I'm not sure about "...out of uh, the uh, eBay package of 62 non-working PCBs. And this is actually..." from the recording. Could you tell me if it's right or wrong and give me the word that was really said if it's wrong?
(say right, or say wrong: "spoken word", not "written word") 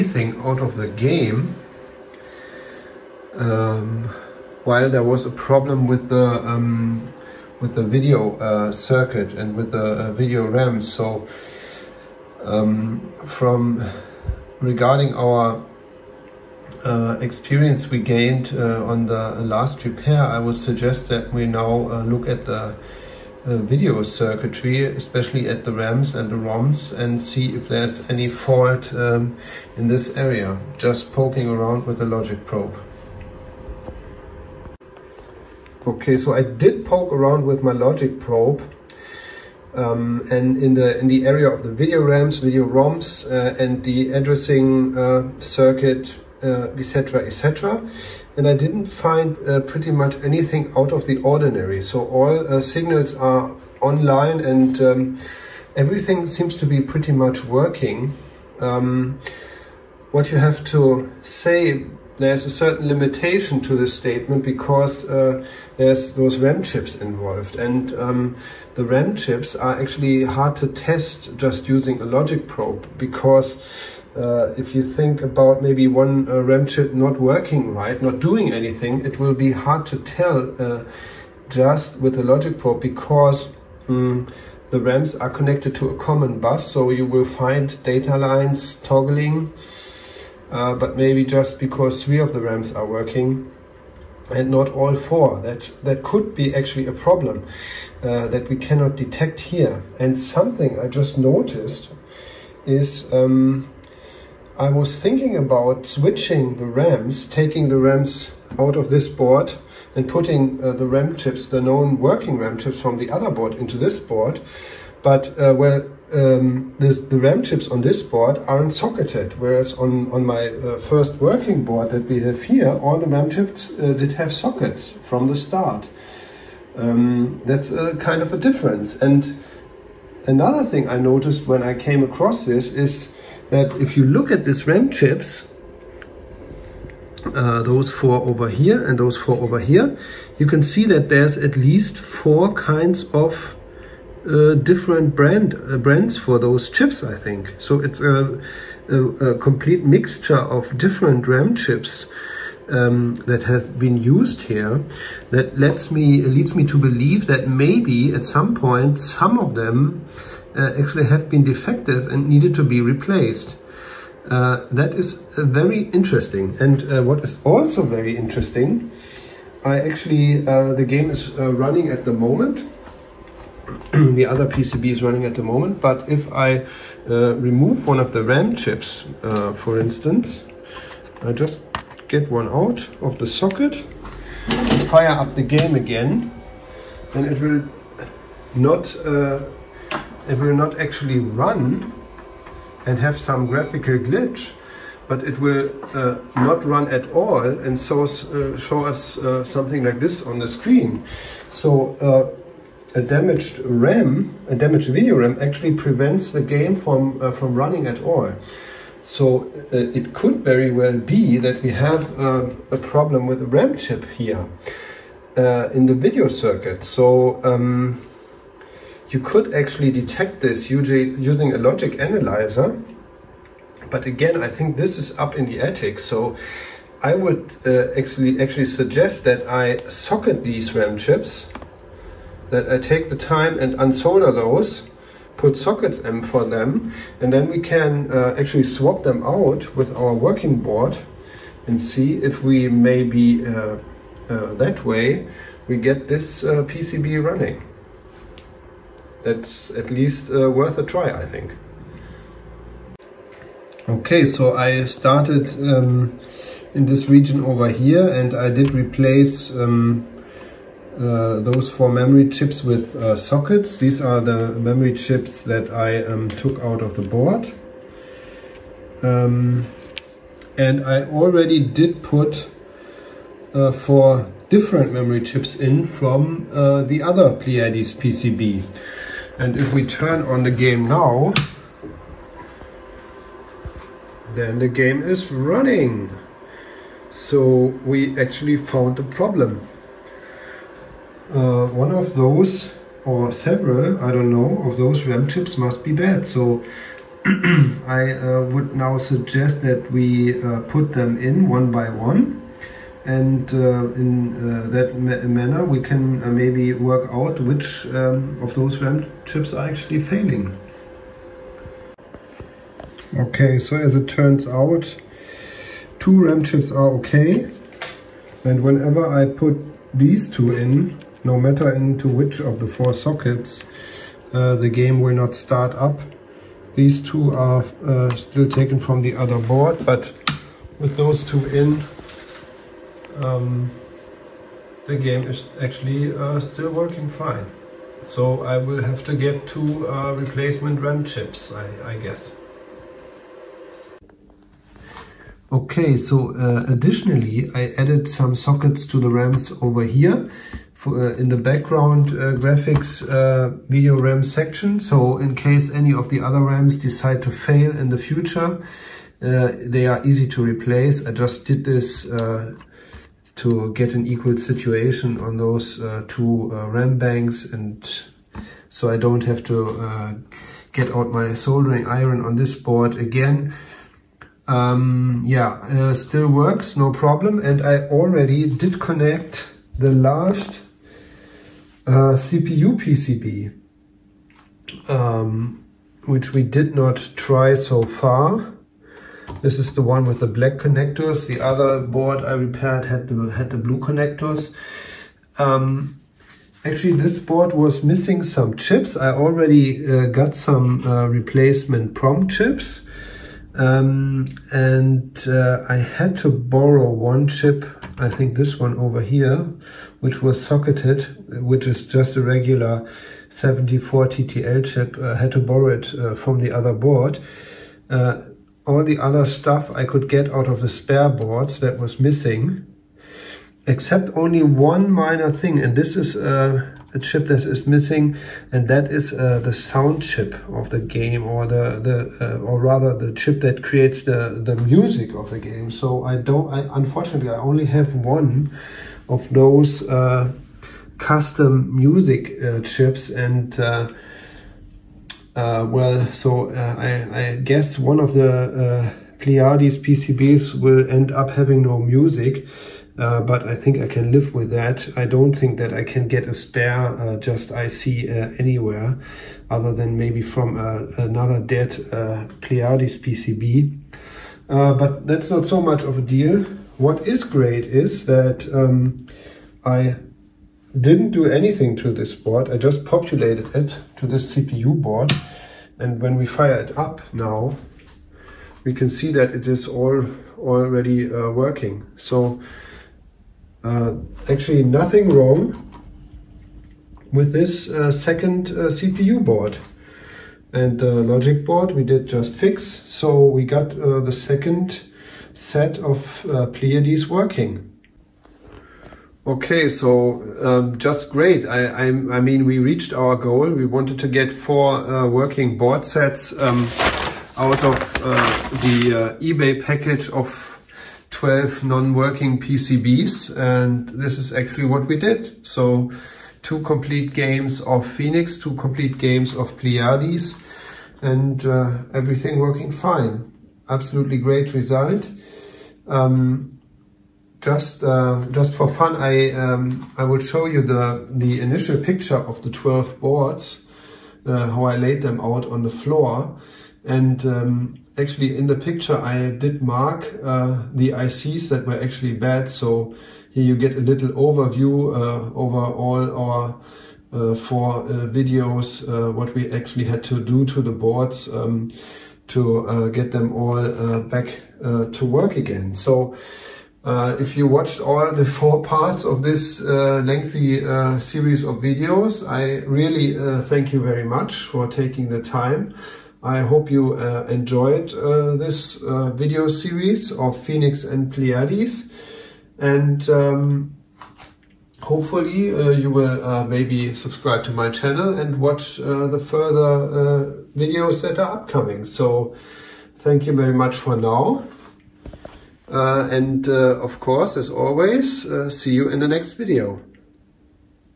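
wrong: "12", not "62".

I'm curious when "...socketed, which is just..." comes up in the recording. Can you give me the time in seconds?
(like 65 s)
410 s.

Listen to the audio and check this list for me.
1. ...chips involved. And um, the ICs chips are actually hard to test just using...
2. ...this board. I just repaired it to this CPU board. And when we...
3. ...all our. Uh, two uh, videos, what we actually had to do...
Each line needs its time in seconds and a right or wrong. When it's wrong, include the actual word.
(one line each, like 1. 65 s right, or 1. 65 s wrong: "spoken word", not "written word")
1. 66 s wrong: "RAM", not "ICs"
2. 471 s wrong: "populated", not "repaired"
3. 545 s wrong: "four", not "two".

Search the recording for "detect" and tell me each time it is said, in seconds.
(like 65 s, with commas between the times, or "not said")
98 s, 219 s.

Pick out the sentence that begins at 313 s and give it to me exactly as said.
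Okay, so as it turns out, two RAM chips are okay.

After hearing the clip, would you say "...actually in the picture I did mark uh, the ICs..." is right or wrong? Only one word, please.
right.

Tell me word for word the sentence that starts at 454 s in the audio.
I don't think that I can get a spare uh, just IC anywhere, other than maybe from another dead Pleiades PCB.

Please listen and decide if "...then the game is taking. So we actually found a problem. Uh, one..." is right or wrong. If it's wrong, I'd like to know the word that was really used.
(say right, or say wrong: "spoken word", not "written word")
wrong: "running", not "taking".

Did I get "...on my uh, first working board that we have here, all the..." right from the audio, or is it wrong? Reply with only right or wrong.
right.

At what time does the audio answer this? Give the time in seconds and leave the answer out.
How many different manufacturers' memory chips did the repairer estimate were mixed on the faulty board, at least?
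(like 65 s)
141 s.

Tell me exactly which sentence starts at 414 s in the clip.
I uh, had to borrow it uh, from the other board.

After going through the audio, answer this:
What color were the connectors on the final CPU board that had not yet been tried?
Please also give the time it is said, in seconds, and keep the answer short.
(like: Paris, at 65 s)
black, at 390 s.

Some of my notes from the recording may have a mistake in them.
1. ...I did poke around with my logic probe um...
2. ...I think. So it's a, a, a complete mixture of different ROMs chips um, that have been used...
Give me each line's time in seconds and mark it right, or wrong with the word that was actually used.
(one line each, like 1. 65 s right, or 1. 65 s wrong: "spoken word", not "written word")
1. 36 s right
2. 147 s wrong: "RAM", not "ROMs".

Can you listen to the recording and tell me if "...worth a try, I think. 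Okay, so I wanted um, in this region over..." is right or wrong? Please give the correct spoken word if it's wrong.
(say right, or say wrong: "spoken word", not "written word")
wrong: "started", not "wanted".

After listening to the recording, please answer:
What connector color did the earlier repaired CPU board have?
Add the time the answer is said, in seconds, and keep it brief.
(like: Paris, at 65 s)
blue, at 393 s.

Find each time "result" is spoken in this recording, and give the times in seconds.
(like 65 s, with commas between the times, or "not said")
524 s.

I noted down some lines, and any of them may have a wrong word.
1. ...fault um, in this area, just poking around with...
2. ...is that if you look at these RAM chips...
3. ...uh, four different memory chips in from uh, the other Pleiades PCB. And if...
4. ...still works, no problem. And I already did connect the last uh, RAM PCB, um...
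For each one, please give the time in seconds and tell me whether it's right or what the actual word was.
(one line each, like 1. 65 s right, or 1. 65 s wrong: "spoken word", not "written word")
1. 28 s right
2. 132 s right
3. 273 s right
4. 375 s wrong: "CPU", not "RAM".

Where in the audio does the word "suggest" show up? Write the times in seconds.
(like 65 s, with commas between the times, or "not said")
20 s, 228 s, 298 s.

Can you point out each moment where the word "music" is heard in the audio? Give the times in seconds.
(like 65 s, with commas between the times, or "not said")
434 s, 441 s, 451 s.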